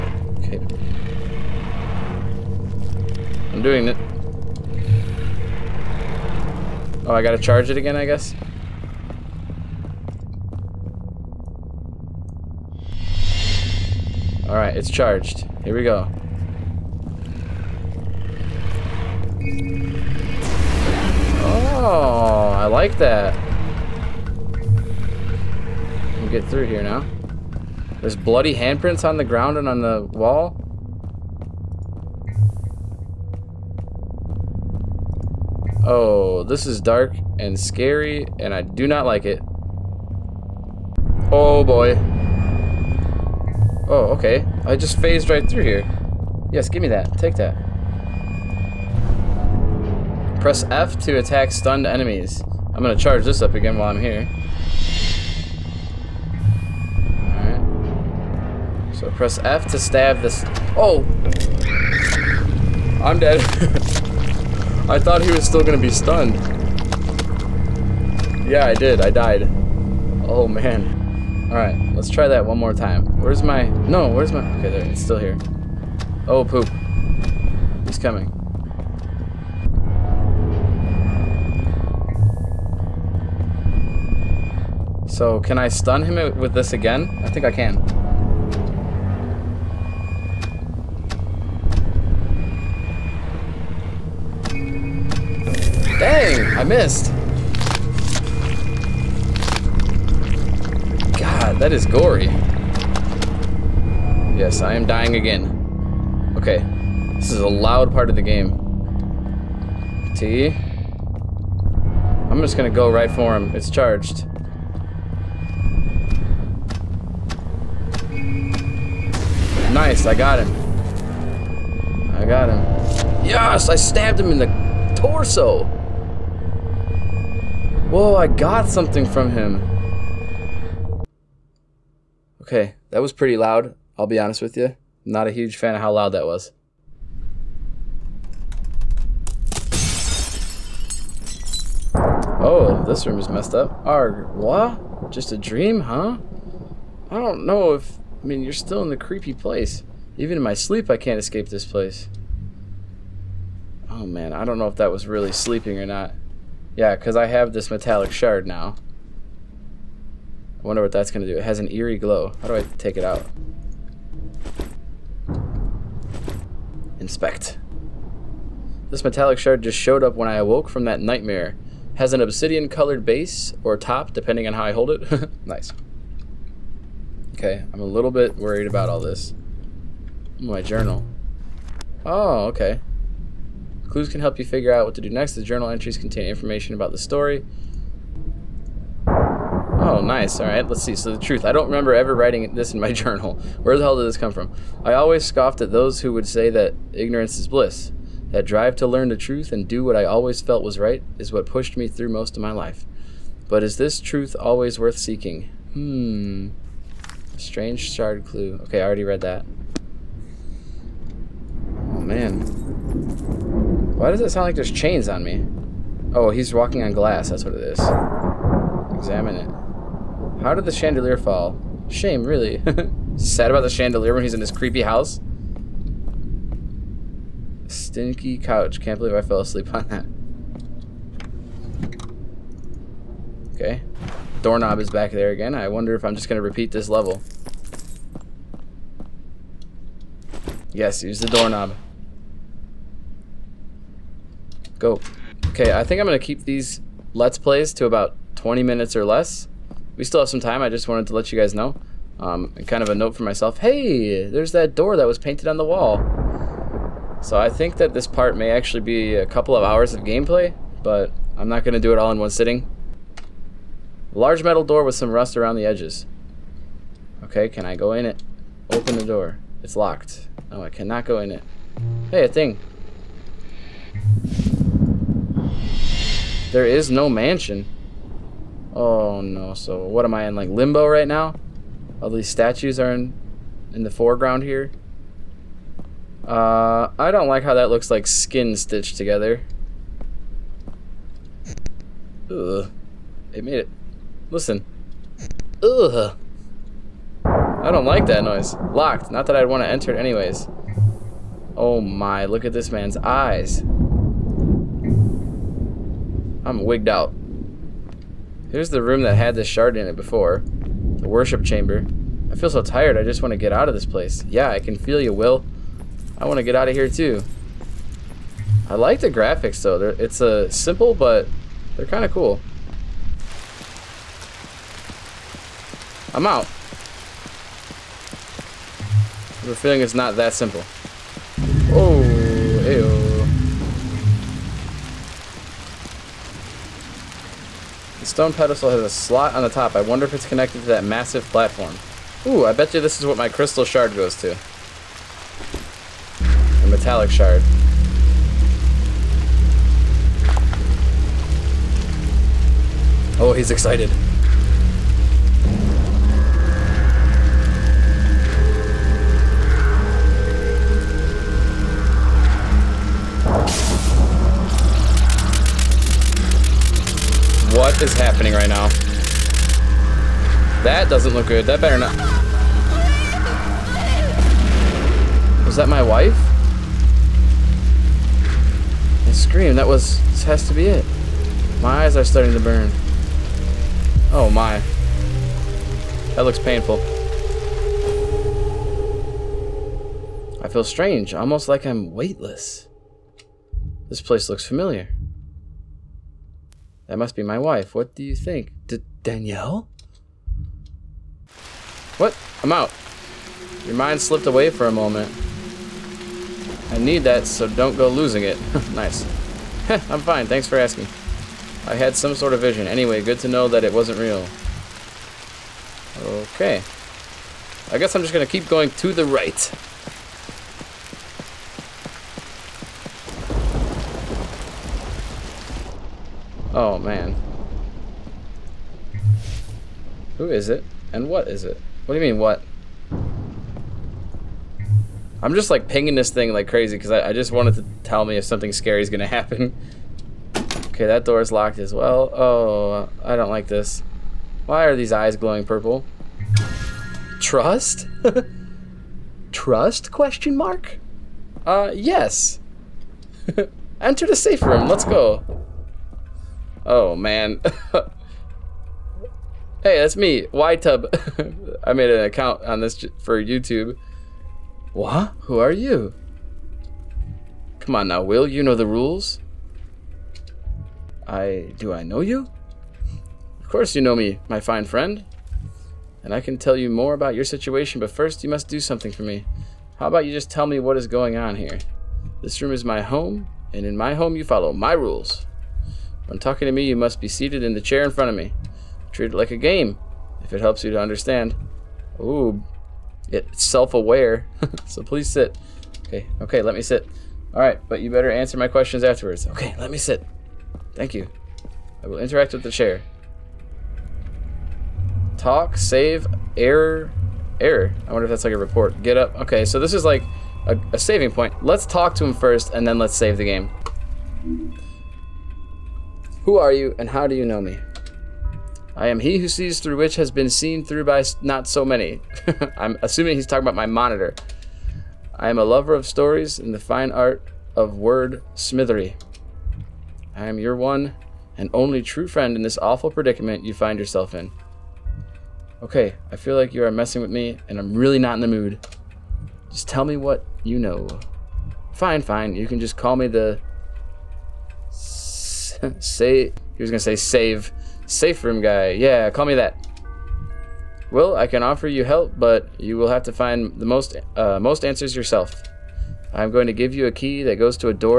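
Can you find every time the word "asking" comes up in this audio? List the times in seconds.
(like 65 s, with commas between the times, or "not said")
410 s.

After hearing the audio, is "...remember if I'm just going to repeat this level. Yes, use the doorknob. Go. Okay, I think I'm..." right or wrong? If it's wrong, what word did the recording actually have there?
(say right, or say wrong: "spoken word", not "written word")
wrong: "wonder", not "remember".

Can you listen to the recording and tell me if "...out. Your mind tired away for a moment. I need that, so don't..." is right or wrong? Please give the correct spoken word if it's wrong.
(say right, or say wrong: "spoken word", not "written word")
wrong: "slipped", not "tired".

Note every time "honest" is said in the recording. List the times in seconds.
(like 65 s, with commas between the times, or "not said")
134 s.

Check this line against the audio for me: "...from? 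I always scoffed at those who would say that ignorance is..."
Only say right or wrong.
right.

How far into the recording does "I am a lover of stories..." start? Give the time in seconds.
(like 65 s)
525 s.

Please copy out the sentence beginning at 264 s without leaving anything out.
Large metal door with some rust around the edges.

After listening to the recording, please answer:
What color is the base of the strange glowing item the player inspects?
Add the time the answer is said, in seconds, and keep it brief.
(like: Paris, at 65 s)
obsidian, at 172 s.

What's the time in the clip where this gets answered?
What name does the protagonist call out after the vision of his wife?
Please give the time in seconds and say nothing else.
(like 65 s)
399 s.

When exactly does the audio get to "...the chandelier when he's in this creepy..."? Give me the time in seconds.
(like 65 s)
223 s.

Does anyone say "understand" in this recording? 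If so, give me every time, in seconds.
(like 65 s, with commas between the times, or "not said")
490 s.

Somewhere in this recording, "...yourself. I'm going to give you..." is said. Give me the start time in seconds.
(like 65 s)
554 s.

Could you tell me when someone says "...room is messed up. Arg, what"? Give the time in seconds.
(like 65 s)
143 s.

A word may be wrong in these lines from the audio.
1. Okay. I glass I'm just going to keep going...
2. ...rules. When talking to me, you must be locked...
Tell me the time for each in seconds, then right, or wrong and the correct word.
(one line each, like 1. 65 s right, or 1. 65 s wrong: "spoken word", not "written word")
1. 416 s wrong: "guess", not "glass"
2. 484 s wrong: "seated", not "locked".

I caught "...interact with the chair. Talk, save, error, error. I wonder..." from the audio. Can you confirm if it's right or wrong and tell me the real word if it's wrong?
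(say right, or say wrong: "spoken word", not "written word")
right.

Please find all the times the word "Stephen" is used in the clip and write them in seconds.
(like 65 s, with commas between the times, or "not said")
not said.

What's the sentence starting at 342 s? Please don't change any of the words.
Ooh, I bet you this is what my crystal shard goes to.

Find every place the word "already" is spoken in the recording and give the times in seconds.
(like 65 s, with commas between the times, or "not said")
208 s.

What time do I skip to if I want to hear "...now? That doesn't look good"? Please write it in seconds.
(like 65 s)
368 s.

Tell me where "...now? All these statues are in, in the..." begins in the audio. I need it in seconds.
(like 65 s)
281 s.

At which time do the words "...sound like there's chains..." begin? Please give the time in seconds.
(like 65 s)
214 s.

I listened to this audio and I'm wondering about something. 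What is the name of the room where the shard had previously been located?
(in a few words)
worship chamber.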